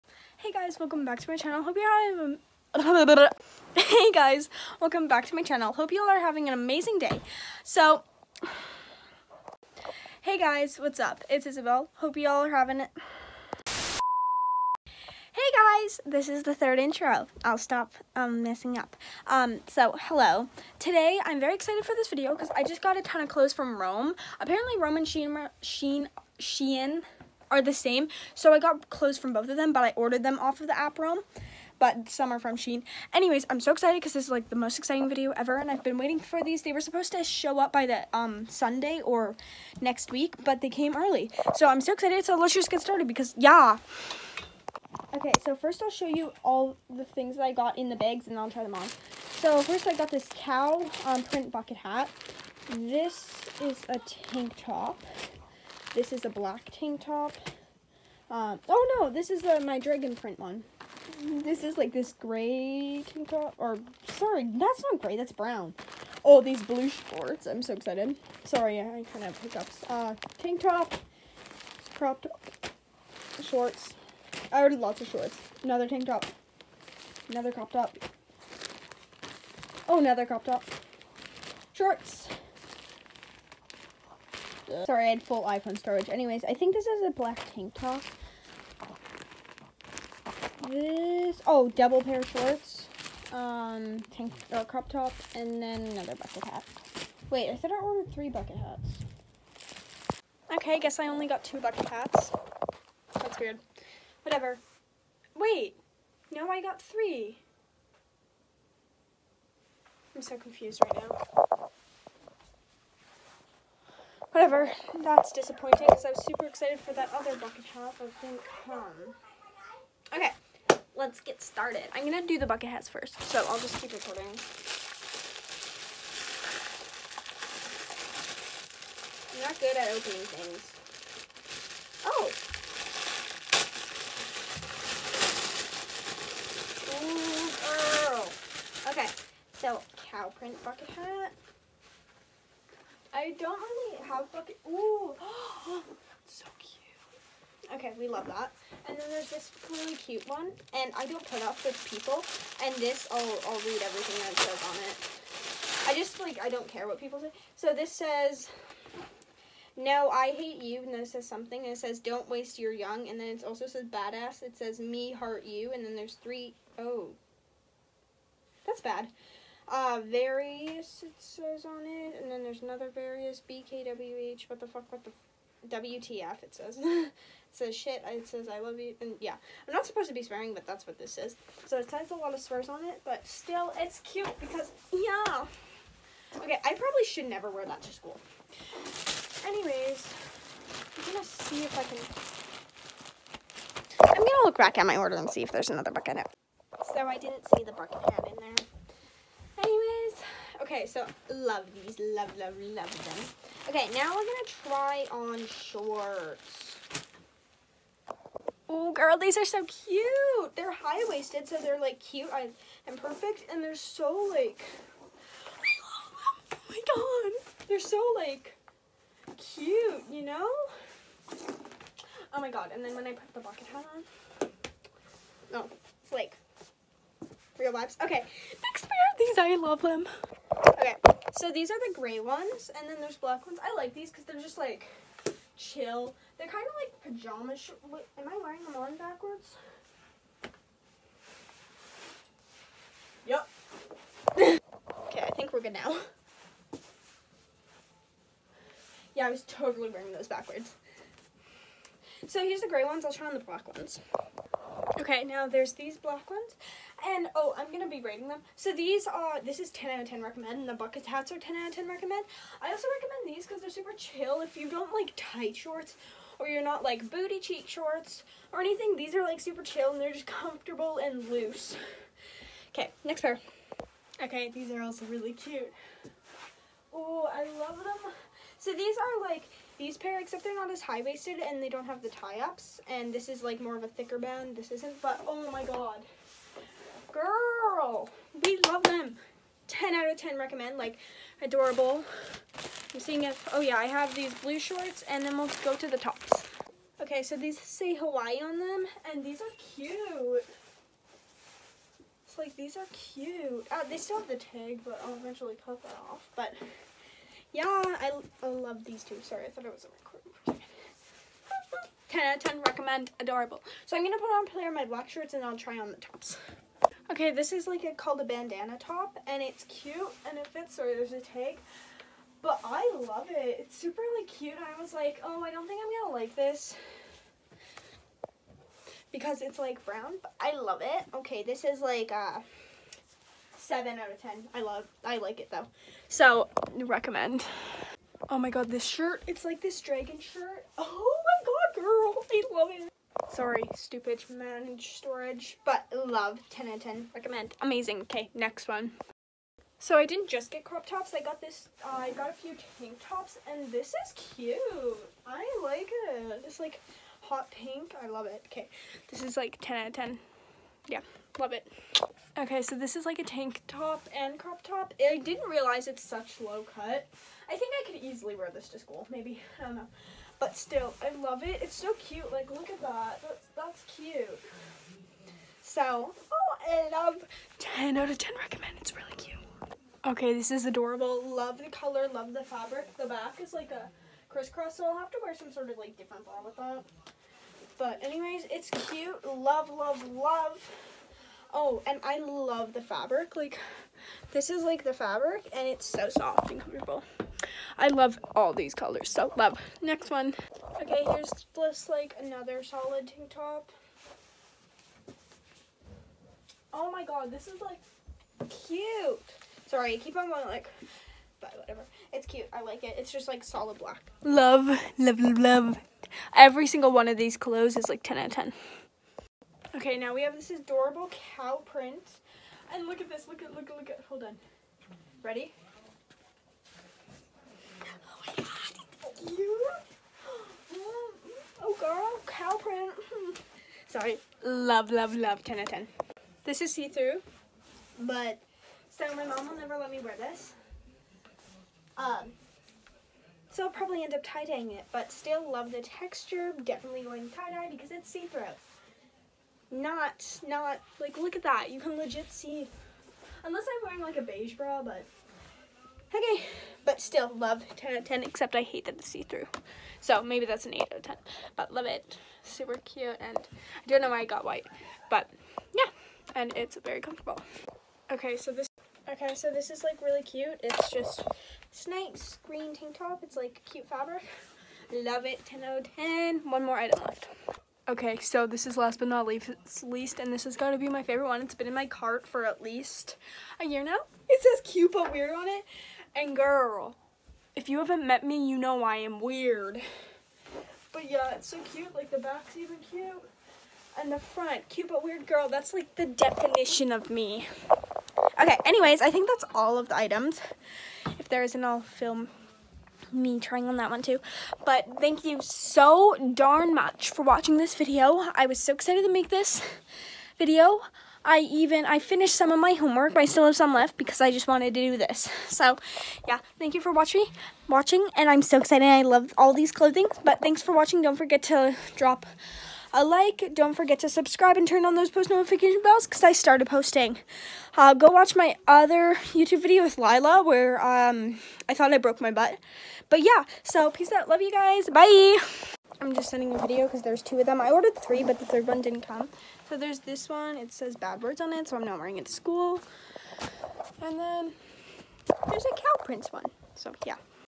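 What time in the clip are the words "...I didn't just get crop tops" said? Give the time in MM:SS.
05:49.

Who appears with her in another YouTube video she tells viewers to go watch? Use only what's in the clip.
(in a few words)
Lila.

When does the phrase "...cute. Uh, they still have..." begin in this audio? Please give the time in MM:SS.
05:02.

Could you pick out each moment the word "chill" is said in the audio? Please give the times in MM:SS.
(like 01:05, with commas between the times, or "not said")
03:55, 04:23, 04:29.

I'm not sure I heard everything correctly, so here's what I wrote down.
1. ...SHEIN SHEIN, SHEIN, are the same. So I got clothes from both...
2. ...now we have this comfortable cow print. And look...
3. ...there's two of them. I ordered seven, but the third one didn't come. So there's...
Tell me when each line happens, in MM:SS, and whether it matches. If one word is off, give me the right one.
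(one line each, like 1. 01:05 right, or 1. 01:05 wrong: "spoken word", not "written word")
1. 00:25 right
2. 06:59 wrong: "adorable", not "comfortable"
3. 08:57 wrong: "three", not "seven".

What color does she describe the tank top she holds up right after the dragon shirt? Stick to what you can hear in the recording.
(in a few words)
Hot pink.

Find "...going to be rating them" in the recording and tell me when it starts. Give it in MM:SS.
04:17.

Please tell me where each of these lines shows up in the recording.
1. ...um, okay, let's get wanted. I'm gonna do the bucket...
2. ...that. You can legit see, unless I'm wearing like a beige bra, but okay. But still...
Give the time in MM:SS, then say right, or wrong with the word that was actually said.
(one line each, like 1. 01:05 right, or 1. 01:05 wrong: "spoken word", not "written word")
1. 01:58 wrong: "started", not "wanted"
2. 07:31 right.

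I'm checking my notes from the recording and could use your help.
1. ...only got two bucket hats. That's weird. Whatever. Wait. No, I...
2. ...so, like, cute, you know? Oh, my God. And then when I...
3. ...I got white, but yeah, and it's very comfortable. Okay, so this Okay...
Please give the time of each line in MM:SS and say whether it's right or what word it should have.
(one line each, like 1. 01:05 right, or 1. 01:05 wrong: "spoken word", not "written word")
1. 01:41 right
2. 03:37 right
3. 07:44 right.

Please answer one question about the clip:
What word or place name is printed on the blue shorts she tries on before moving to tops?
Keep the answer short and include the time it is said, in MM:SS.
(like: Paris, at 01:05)
Hawaii, at 04:57.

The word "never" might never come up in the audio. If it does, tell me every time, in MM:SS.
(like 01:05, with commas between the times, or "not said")
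03:07, 07:19.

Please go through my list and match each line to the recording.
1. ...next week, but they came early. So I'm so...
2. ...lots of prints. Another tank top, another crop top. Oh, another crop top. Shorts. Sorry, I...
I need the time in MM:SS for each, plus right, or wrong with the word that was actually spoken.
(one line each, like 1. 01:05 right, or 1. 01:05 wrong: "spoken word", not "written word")
1. 00:39 right
2. 01:14 wrong: "shorts", not "prints".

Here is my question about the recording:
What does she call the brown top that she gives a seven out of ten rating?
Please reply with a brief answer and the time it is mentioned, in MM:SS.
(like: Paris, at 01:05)
Bandana top, at 05:18.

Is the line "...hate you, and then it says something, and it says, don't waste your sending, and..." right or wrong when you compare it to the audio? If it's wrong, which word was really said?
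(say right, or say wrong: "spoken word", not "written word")
wrong: "young", not "sending".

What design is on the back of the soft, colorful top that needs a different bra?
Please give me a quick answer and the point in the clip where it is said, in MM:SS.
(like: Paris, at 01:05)
Crisscross, at 06:24.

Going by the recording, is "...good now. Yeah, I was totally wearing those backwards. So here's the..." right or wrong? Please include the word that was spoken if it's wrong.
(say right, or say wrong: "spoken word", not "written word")
right.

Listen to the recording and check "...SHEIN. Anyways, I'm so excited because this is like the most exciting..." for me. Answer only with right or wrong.
right.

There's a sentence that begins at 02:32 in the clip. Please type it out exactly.
And this, I'll I'll read everything that says on it.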